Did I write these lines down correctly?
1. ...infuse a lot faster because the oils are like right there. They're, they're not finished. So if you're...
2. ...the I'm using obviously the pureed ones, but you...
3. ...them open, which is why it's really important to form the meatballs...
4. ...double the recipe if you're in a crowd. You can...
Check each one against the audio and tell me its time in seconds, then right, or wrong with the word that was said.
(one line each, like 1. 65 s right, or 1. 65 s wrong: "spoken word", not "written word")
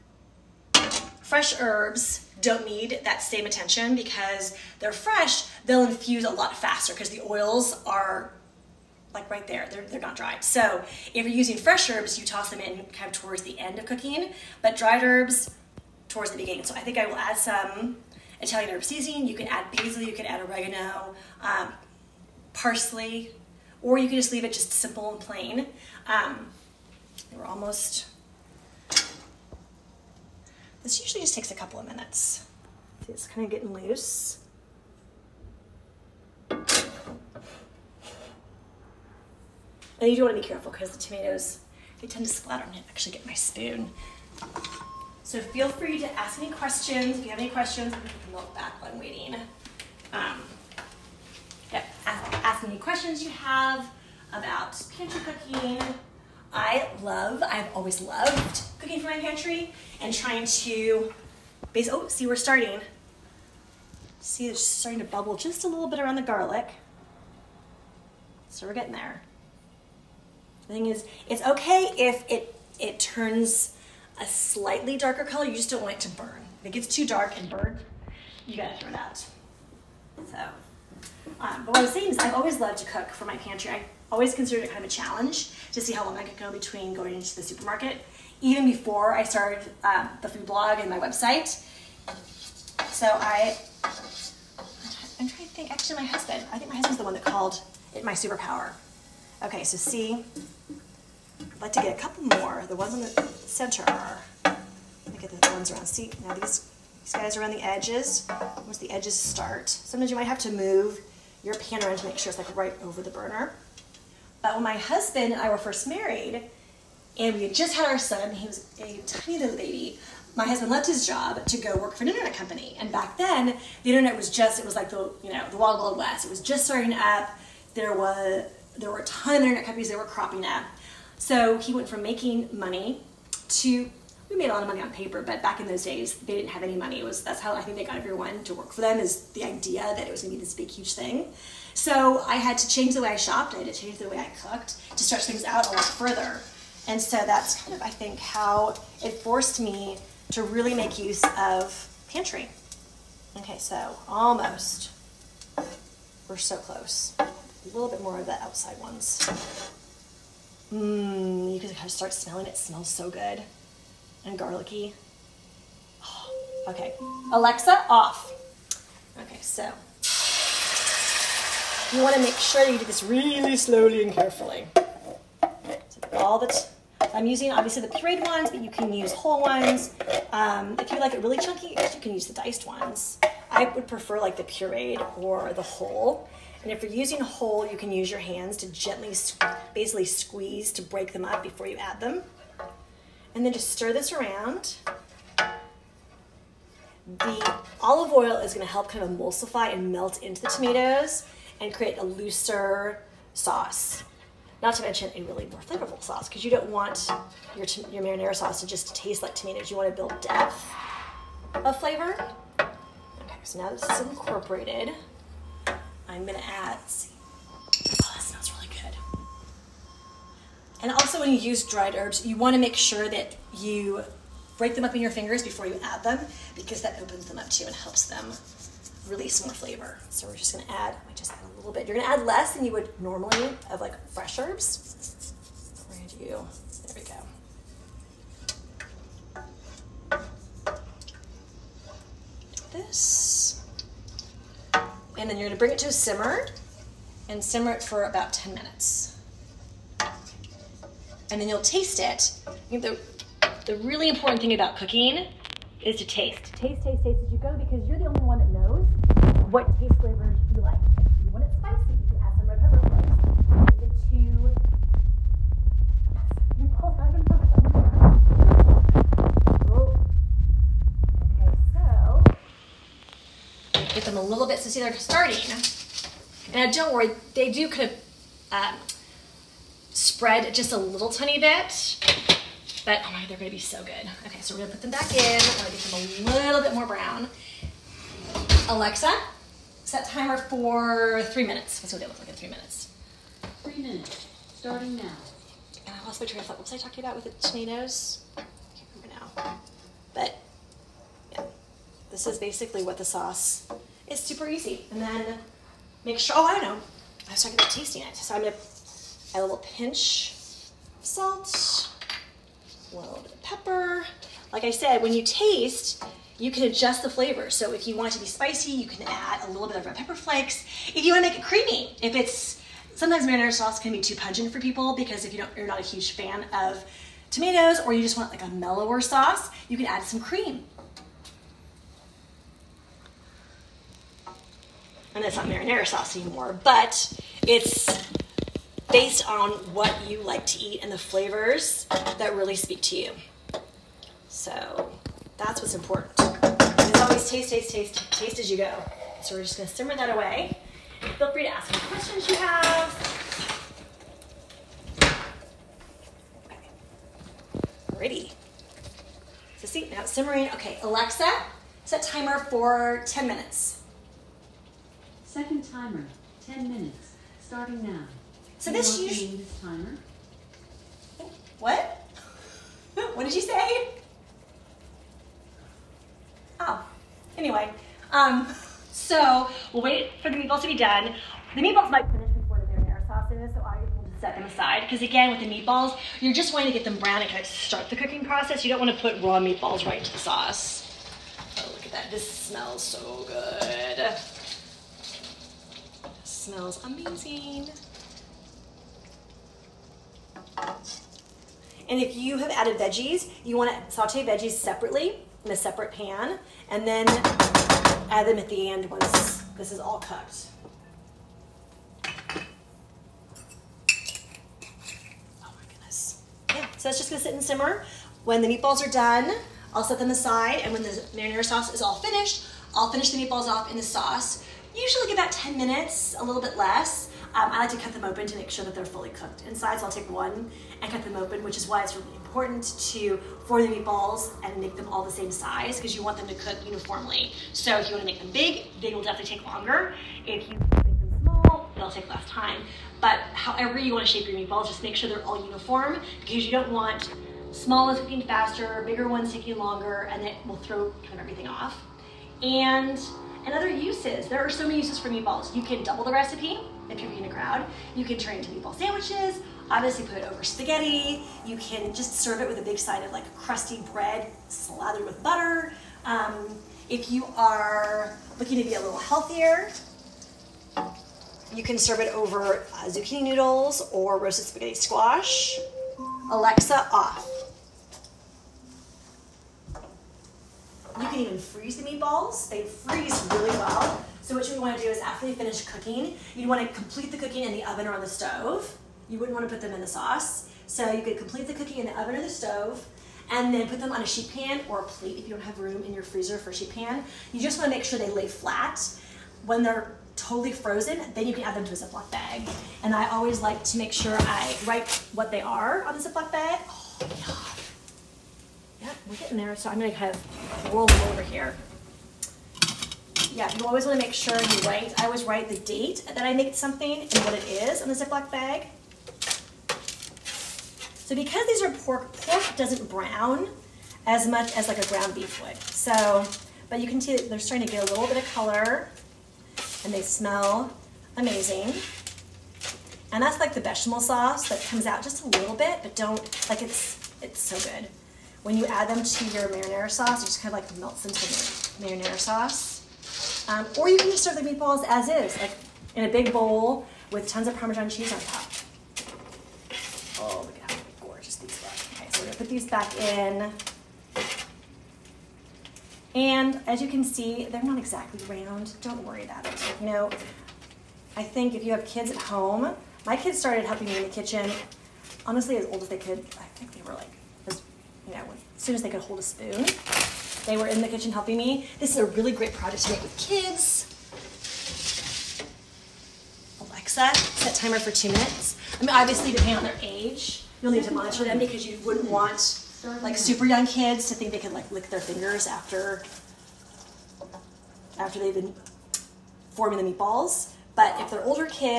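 1. 5 s wrong: "dried", not "finished"
2. 176 s right
3. 431 s right
4. 455 s right.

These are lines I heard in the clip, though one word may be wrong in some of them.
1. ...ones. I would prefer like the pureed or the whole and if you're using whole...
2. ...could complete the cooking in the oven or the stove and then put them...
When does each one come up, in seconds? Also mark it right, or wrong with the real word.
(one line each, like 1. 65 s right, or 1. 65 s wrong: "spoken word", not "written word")
1. 182 s right
2. 491 s right.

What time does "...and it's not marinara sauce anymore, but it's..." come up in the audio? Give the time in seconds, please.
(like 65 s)
335 s.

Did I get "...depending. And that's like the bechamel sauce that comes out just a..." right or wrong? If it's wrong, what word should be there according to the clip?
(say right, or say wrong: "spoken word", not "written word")
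wrong: "amazing", not "depending".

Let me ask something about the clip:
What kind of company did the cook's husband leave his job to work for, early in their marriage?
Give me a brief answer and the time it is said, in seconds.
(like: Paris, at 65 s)
internet company, at 122 s.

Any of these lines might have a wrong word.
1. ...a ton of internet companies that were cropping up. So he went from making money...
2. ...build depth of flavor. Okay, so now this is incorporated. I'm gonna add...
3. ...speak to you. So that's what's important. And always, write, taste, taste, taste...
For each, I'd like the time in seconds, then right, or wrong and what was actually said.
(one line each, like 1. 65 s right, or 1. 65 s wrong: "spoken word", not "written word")
1. 129 s right
2. 209 s right
3. 342 s wrong: "taste", not "write".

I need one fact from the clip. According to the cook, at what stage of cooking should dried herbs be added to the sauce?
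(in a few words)
towards the beginning.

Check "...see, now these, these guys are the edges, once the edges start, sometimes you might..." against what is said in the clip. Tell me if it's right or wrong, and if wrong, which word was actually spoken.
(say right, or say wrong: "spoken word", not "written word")
right.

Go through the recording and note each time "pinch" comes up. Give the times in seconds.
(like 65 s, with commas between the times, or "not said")
309 s.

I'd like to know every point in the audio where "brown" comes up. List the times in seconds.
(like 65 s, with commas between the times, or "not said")
286 s, 386 s, 522 s.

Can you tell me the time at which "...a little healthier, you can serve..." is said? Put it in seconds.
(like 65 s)
468 s.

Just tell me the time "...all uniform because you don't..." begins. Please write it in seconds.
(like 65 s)
445 s.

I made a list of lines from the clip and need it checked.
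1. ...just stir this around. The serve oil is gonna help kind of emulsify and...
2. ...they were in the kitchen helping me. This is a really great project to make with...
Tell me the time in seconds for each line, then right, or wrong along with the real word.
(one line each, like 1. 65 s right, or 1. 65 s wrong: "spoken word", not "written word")
1. 193 s wrong: "olive", not "serve"
2. 570 s right.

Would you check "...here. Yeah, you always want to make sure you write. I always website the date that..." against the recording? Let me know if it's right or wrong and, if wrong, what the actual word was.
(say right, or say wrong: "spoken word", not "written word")
wrong: "write", not "website".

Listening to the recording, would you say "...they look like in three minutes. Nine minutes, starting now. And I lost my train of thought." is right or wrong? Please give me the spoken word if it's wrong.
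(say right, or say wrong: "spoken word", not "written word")
wrong: "Three", not "Nine".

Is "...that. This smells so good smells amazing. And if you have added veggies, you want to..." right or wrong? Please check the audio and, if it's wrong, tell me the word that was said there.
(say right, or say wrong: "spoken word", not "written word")
right.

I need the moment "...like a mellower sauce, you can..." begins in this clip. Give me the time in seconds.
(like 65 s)
328 s.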